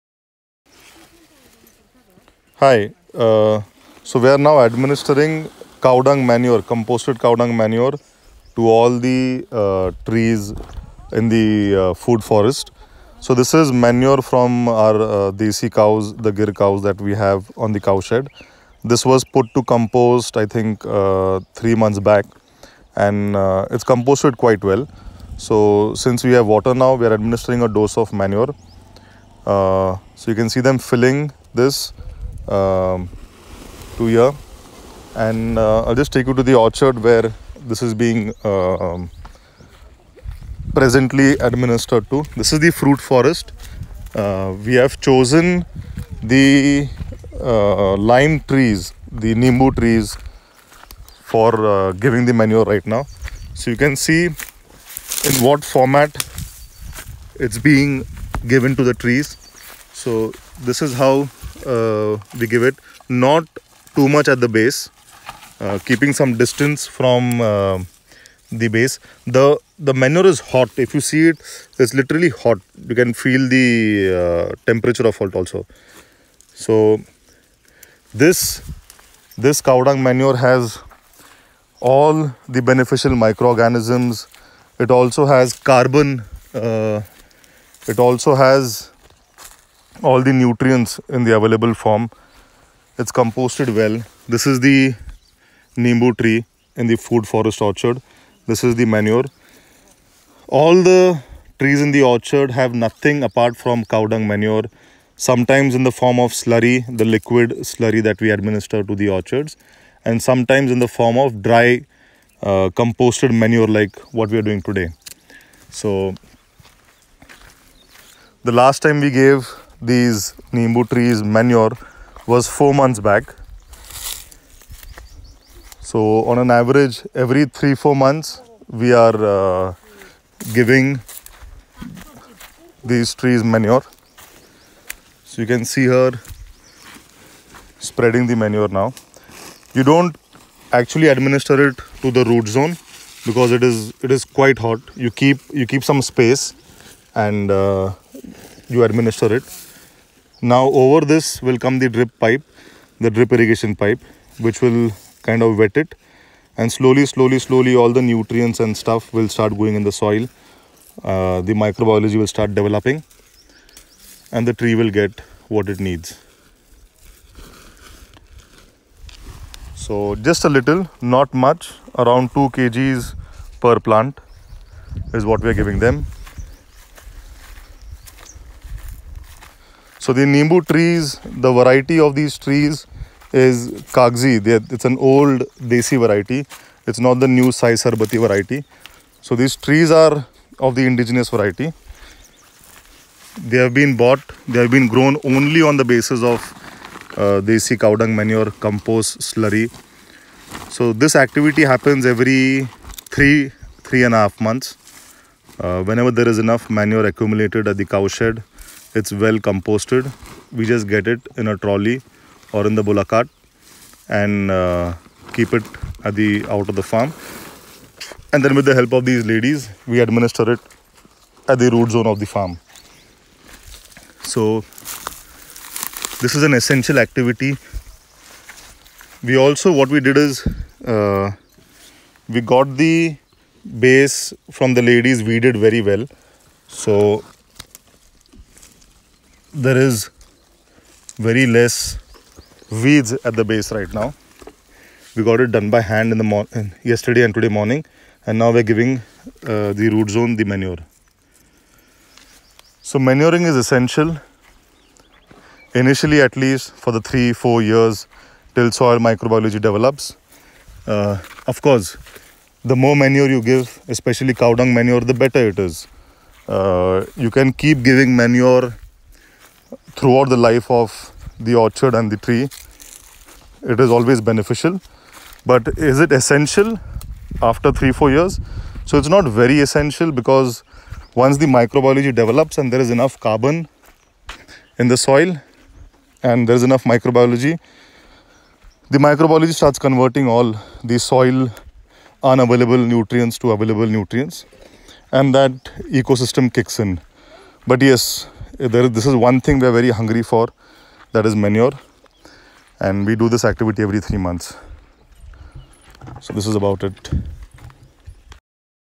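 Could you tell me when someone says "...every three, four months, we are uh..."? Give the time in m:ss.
2:07.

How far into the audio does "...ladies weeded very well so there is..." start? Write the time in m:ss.
3:54.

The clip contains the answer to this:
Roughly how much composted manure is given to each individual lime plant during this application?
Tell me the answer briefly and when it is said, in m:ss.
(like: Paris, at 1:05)
2 kg, at 2:52.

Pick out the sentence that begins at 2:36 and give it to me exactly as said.
And slowly, slowly, slowly, all the nutrients and stuff will start going in the soil.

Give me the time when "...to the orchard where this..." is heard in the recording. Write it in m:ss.
0:36.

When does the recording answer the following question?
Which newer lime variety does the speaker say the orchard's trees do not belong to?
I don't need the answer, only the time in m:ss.
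3:07.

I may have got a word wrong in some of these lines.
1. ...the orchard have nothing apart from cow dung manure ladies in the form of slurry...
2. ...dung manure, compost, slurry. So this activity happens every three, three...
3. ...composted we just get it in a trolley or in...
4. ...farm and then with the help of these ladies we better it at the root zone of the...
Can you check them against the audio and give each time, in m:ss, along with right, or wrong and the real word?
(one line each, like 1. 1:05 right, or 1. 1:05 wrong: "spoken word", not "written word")
1. 1:41 wrong: "sometimes", not "ladies"
2. 3:17 right
3. 3:29 right
4. 3:36 wrong: "administer", not "better".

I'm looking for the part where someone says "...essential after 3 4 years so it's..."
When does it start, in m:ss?
4:36.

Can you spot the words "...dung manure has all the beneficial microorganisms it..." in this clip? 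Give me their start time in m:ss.
1:19.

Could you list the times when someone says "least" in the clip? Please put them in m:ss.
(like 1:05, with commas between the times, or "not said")
4:16.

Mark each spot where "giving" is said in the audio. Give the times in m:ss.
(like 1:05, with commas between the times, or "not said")
0:51, 2:10, 2:55, 4:08, 4:27.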